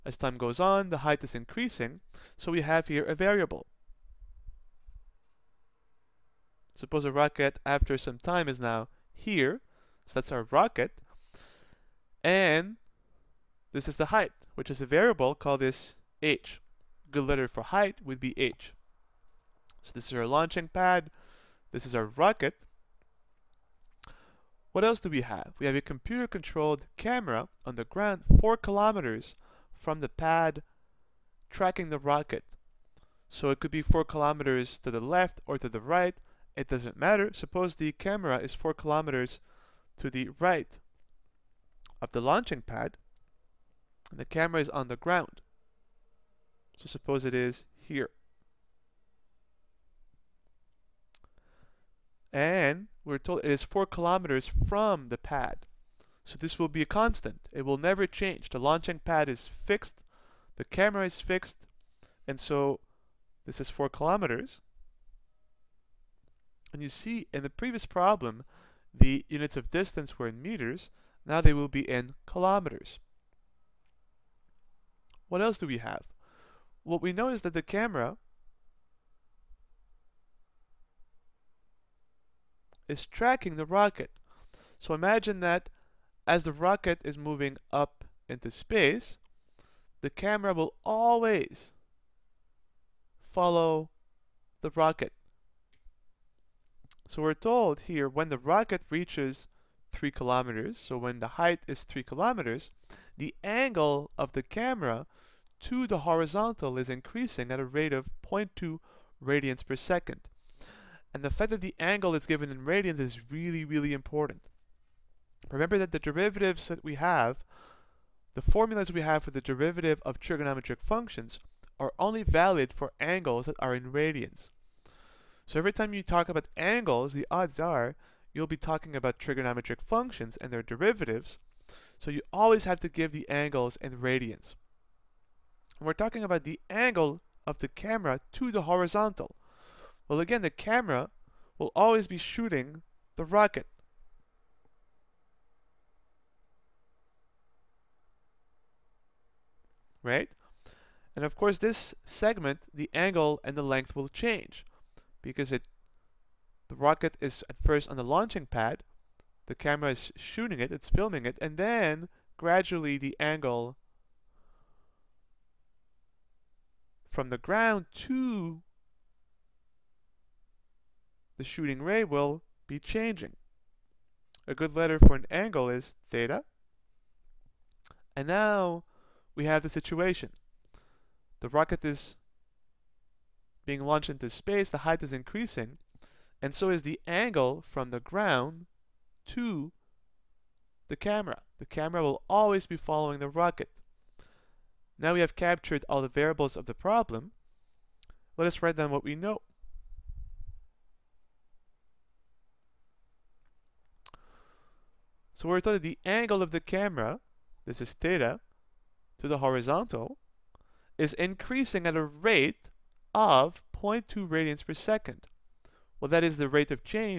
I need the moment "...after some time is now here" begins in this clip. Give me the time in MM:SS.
00:07.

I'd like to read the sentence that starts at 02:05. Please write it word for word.
So every time you talk about angles, the odds are you'll be talking about trigonometric functions and their derivatives.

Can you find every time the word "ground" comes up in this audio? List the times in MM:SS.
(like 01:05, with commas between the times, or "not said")
00:27, 00:44, 02:47, 03:07.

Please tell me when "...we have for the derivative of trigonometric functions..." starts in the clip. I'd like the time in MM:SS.
01:58.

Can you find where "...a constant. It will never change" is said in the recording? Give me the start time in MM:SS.
00:56.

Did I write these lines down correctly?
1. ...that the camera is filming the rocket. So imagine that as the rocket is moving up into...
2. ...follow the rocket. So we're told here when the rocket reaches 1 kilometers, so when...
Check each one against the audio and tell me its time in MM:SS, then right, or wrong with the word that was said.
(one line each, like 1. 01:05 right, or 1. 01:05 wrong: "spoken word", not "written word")
1. 01:17 wrong: "tracking", not "filming"
2. 01:33 wrong: "3", not "1".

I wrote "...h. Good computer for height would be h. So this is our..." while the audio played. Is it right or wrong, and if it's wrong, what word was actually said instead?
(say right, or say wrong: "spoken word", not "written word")
wrong: "letter", not "computer".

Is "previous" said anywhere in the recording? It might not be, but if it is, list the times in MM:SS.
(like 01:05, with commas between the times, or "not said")
01:07.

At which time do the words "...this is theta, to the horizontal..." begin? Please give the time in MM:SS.
03:27.